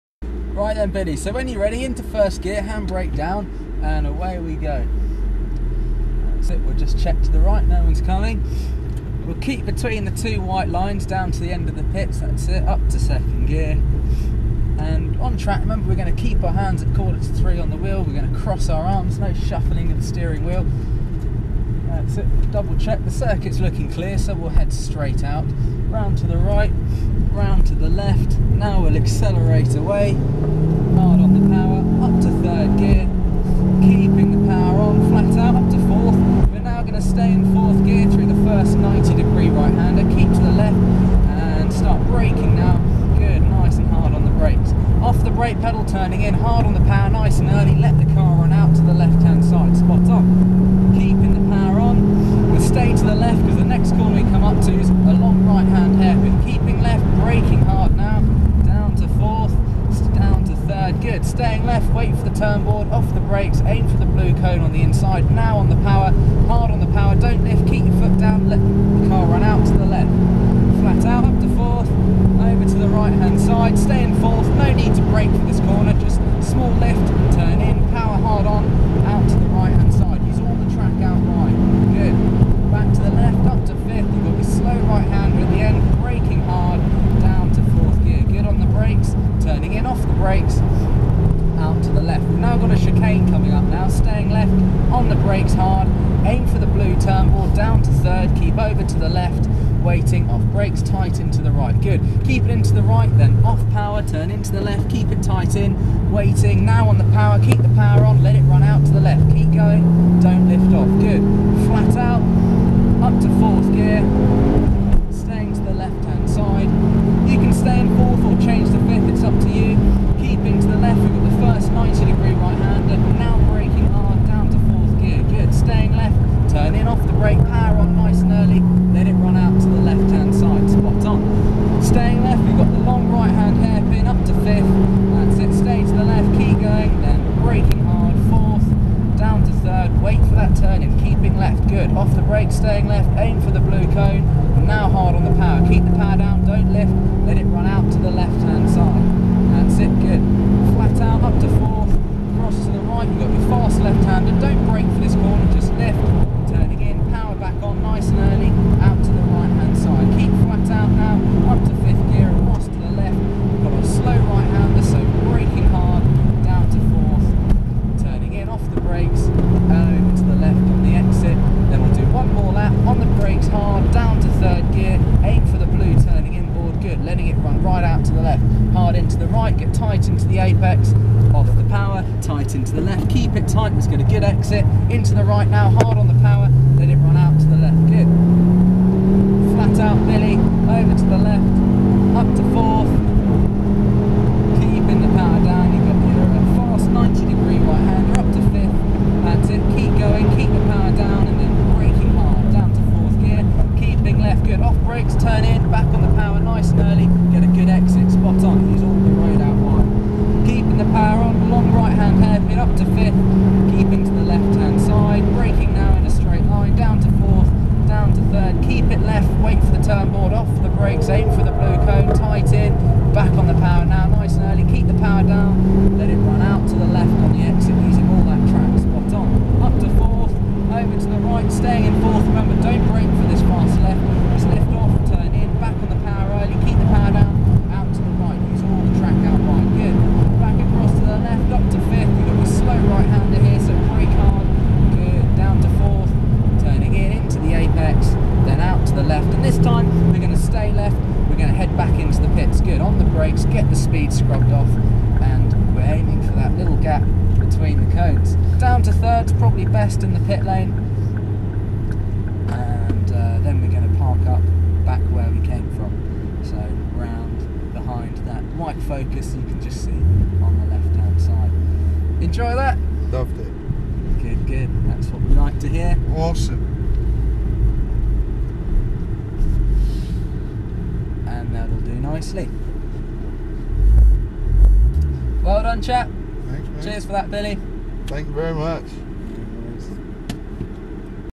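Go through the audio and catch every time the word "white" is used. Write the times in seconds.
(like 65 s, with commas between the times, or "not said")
10 s, 268 s.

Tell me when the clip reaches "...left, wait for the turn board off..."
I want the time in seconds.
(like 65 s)
219 s.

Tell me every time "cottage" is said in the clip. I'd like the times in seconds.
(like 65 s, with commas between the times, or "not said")
not said.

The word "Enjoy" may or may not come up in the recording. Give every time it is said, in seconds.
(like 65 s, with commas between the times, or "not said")
272 s.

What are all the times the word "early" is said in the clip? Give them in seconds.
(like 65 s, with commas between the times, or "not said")
47 s, 224 s.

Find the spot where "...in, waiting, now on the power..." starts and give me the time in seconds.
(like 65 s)
105 s.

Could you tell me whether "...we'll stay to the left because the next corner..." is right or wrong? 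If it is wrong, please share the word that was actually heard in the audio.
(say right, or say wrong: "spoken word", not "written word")
right.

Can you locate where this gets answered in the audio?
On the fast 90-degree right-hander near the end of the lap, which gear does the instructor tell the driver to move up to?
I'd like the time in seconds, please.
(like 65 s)
198 s.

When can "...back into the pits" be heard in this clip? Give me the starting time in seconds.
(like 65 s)
251 s.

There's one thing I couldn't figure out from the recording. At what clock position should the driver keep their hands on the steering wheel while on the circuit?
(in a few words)
Quarter to three.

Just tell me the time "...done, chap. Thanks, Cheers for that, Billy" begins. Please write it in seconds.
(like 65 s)
285 s.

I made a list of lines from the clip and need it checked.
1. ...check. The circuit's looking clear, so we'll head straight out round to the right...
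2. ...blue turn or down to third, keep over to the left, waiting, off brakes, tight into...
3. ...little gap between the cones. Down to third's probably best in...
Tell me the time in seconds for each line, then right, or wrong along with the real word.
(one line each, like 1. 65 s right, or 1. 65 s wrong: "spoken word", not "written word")
1. 22 s right
2. 96 s right
3. 256 s right.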